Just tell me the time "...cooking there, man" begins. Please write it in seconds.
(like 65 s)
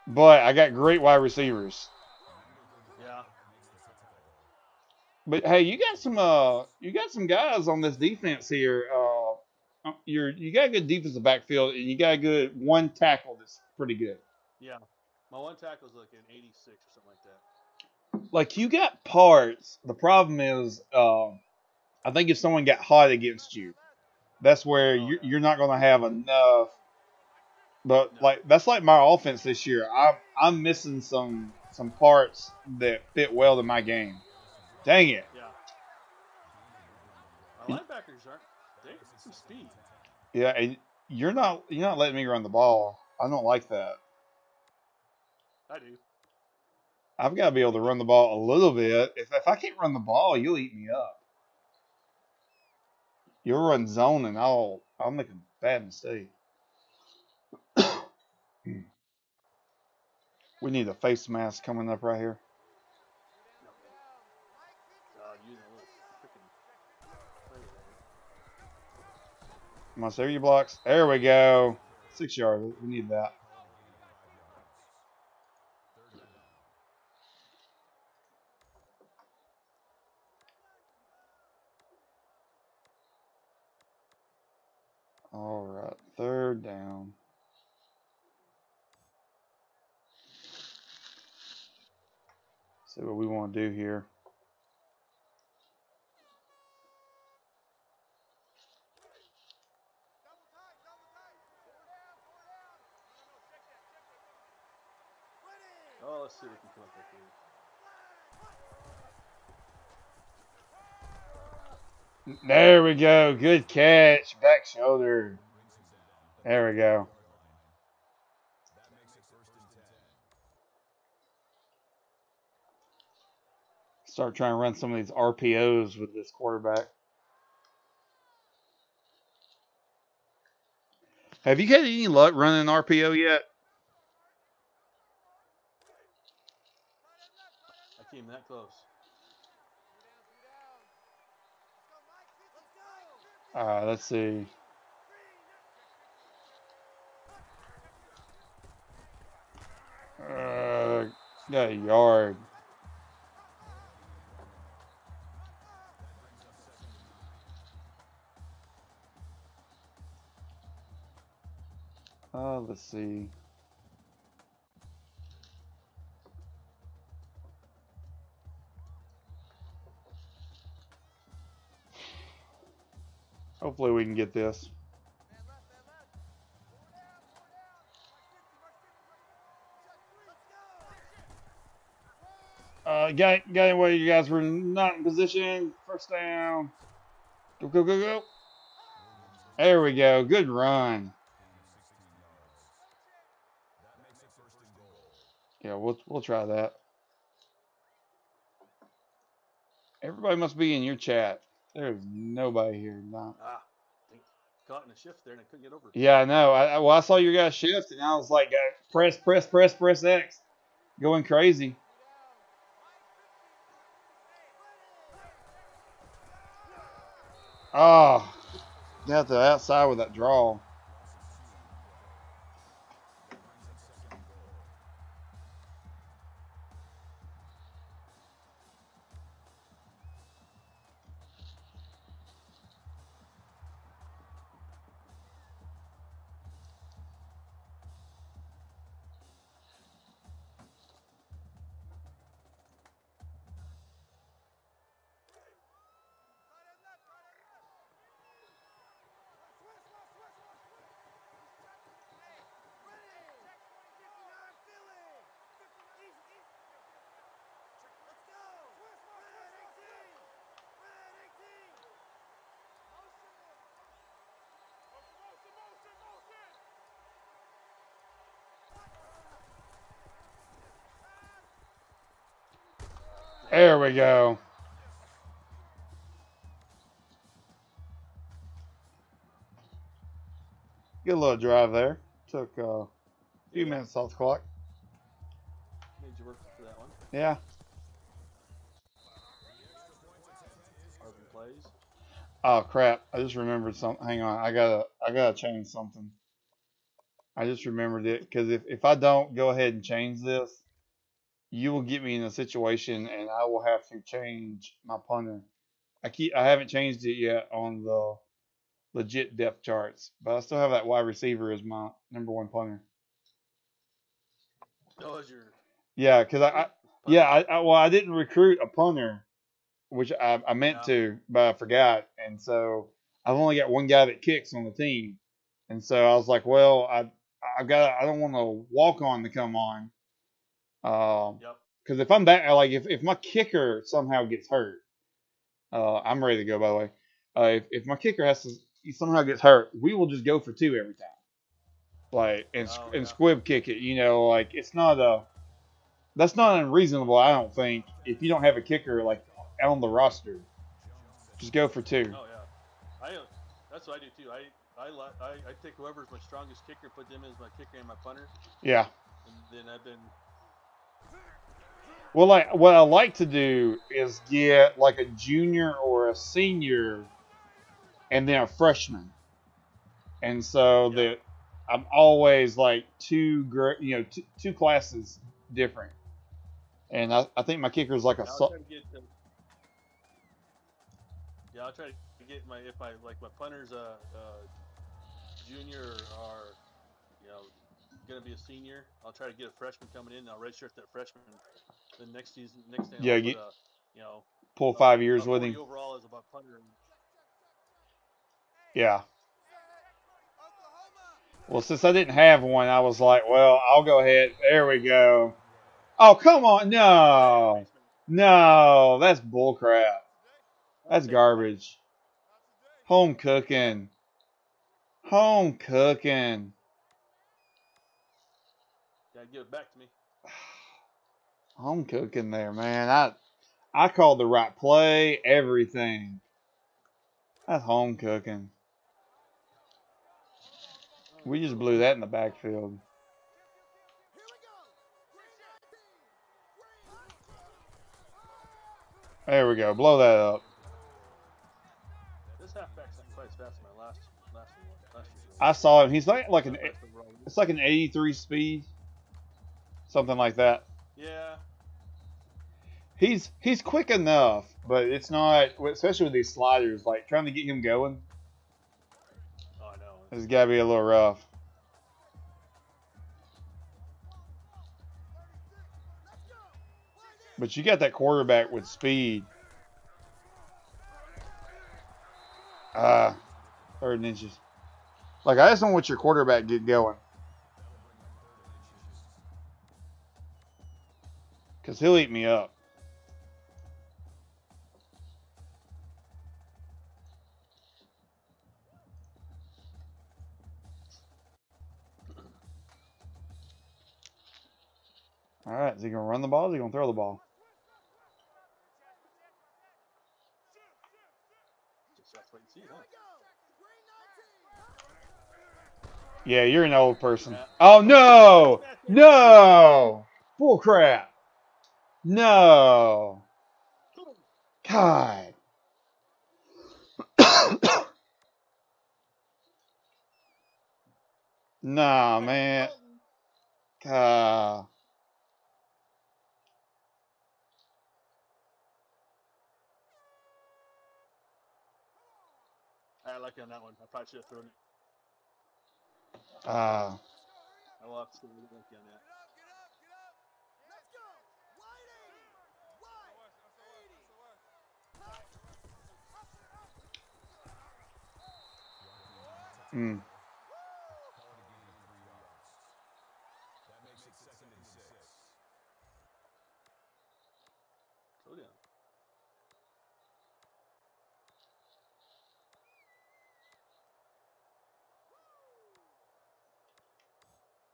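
421 s.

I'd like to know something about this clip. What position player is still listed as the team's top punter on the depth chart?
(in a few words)
wide receiver.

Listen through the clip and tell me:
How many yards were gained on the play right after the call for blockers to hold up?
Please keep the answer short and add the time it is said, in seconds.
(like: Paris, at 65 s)
6, at 72 s.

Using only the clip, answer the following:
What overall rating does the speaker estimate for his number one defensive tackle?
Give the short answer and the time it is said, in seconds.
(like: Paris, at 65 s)
86, at 15 s.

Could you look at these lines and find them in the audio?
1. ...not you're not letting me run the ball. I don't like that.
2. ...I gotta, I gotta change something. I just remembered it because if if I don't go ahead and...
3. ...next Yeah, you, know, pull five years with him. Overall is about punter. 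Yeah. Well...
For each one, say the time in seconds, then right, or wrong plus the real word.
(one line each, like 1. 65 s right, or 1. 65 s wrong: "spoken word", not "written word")
1. 41 s right
2. 294 s right
3. 392 s right.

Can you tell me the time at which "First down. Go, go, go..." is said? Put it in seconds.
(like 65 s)
185 s.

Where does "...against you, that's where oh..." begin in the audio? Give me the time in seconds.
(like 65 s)
23 s.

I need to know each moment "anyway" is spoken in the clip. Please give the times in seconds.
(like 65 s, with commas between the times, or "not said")
183 s.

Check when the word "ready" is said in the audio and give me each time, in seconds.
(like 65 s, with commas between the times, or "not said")
336 s.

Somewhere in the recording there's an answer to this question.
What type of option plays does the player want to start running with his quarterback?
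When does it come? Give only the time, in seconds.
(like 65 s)
125 s.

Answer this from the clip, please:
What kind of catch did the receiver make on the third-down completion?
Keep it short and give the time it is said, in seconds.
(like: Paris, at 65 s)
Back shoulder, at 114 s.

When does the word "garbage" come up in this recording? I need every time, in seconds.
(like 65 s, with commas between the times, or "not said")
411 s.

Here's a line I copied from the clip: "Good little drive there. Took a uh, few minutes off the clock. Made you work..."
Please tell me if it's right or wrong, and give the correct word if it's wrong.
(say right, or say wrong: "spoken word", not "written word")
right.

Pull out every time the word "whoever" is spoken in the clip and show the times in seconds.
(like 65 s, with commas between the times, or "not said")
355 s.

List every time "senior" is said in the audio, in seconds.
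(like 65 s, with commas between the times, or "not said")
366 s, 388 s.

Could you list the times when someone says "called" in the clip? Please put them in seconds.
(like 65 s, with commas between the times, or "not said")
423 s.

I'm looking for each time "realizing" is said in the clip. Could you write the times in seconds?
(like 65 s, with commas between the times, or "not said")
not said.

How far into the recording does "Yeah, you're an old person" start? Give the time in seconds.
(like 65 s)
506 s.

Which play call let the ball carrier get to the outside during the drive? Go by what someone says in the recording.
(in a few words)
draw.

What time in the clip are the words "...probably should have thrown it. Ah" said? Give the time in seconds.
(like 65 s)
533 s.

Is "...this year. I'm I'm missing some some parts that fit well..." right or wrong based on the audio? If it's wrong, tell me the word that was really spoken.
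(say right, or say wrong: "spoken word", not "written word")
right.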